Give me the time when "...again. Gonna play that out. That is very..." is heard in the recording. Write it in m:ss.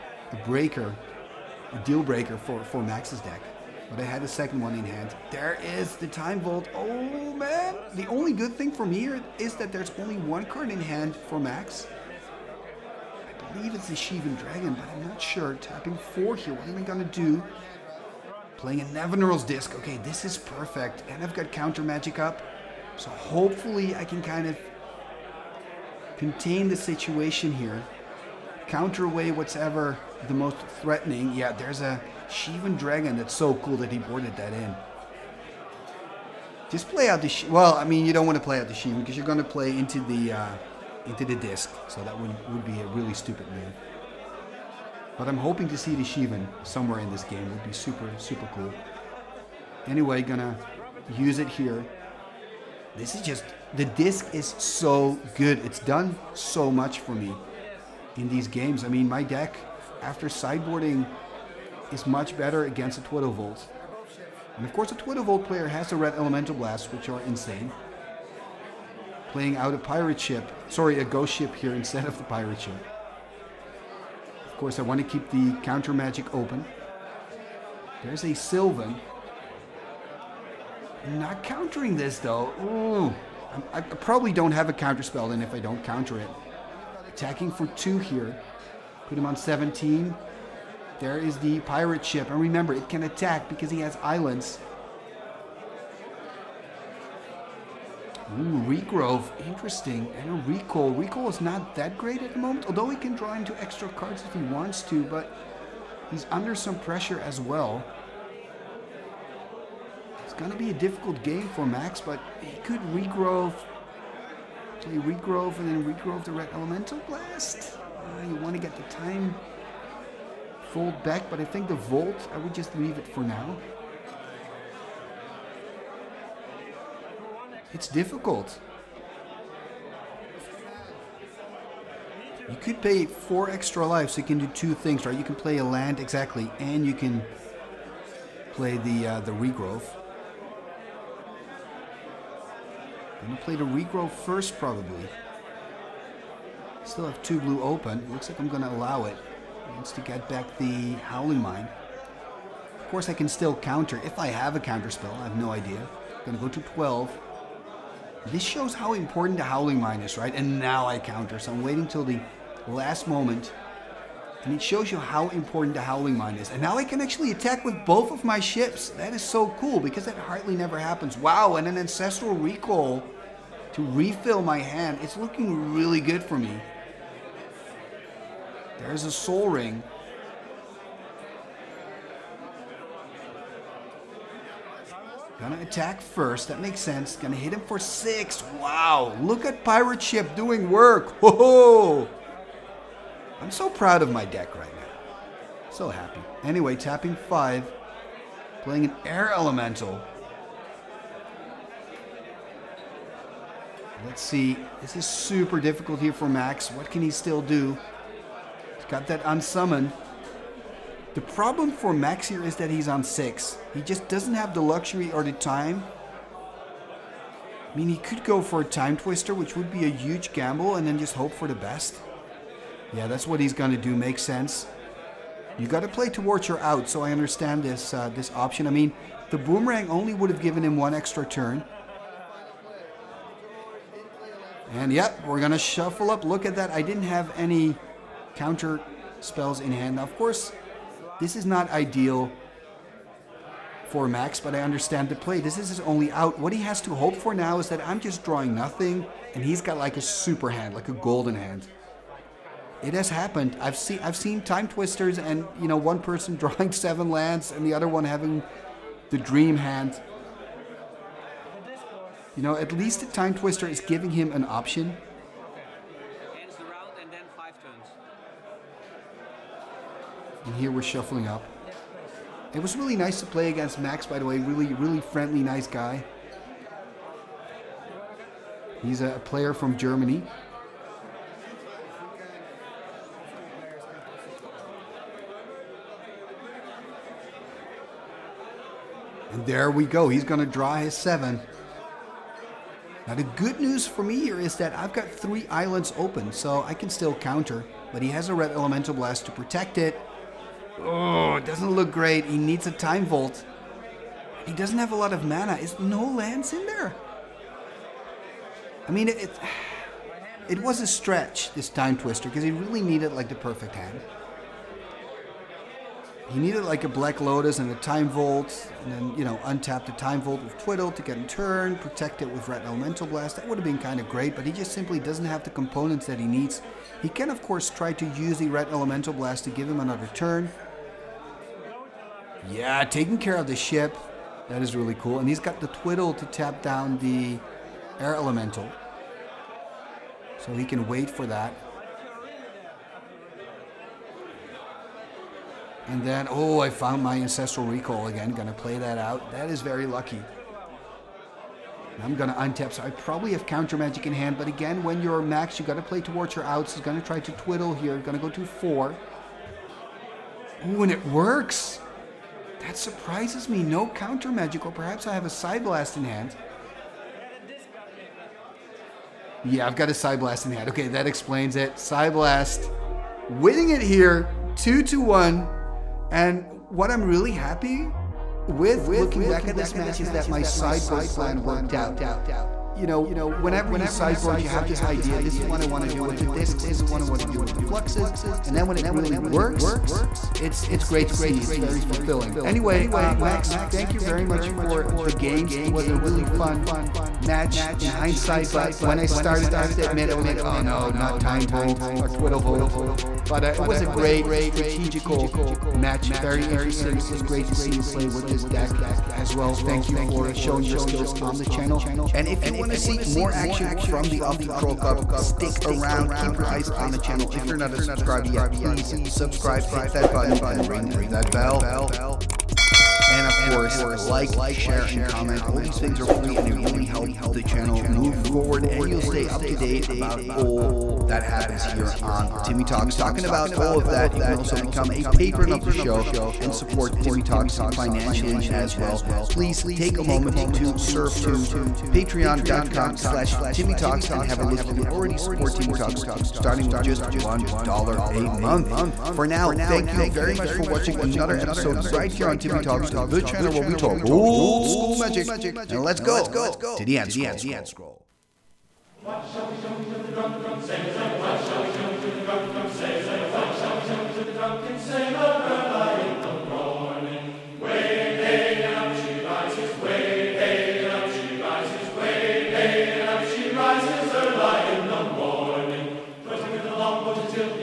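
5:48.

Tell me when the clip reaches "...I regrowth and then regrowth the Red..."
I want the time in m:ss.
1:55.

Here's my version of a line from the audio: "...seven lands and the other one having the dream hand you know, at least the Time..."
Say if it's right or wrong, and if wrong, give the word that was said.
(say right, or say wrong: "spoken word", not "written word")
right.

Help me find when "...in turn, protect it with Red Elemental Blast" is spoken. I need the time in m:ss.
5:21.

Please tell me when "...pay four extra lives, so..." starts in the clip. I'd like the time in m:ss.
2:12.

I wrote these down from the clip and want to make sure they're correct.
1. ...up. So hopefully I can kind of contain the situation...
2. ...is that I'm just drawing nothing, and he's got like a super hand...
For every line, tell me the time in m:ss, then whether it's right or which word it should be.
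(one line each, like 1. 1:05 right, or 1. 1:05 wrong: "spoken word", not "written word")
1. 0:22 right
2. 4:07 right.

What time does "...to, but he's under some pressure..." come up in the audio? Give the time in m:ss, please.
1:44.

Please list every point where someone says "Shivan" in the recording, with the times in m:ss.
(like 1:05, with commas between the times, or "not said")
0:13, 0:32, 0:38, 0:46.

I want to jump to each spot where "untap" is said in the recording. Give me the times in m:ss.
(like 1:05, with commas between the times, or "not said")
5:19, 5:52.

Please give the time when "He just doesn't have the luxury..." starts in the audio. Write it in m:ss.
3:33.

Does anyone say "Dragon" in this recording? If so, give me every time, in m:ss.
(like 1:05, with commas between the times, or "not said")
0:14, 0:32.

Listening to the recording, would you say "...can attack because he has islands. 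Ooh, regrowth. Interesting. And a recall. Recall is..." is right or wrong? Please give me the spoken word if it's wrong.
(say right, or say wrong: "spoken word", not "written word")
right.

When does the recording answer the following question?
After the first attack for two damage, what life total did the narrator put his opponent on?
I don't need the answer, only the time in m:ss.
1:29.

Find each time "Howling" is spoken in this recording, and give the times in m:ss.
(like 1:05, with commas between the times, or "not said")
2:31, 2:39, 2:45.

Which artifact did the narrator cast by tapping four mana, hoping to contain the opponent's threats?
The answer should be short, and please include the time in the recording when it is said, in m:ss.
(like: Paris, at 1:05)
Nevinyrral's Disk, at 0:18.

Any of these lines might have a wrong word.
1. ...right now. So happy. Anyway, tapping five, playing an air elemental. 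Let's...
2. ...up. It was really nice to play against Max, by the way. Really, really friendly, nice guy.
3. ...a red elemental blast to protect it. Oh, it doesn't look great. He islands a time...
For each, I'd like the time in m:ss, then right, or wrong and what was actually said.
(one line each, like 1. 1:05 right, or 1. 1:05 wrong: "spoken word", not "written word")
1. 3:14 right
2. 4:31 right
3. 4:58 wrong: "needs", not "islands".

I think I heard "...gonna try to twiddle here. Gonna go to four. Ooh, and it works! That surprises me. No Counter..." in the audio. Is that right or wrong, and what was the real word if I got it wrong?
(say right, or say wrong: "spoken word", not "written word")
right.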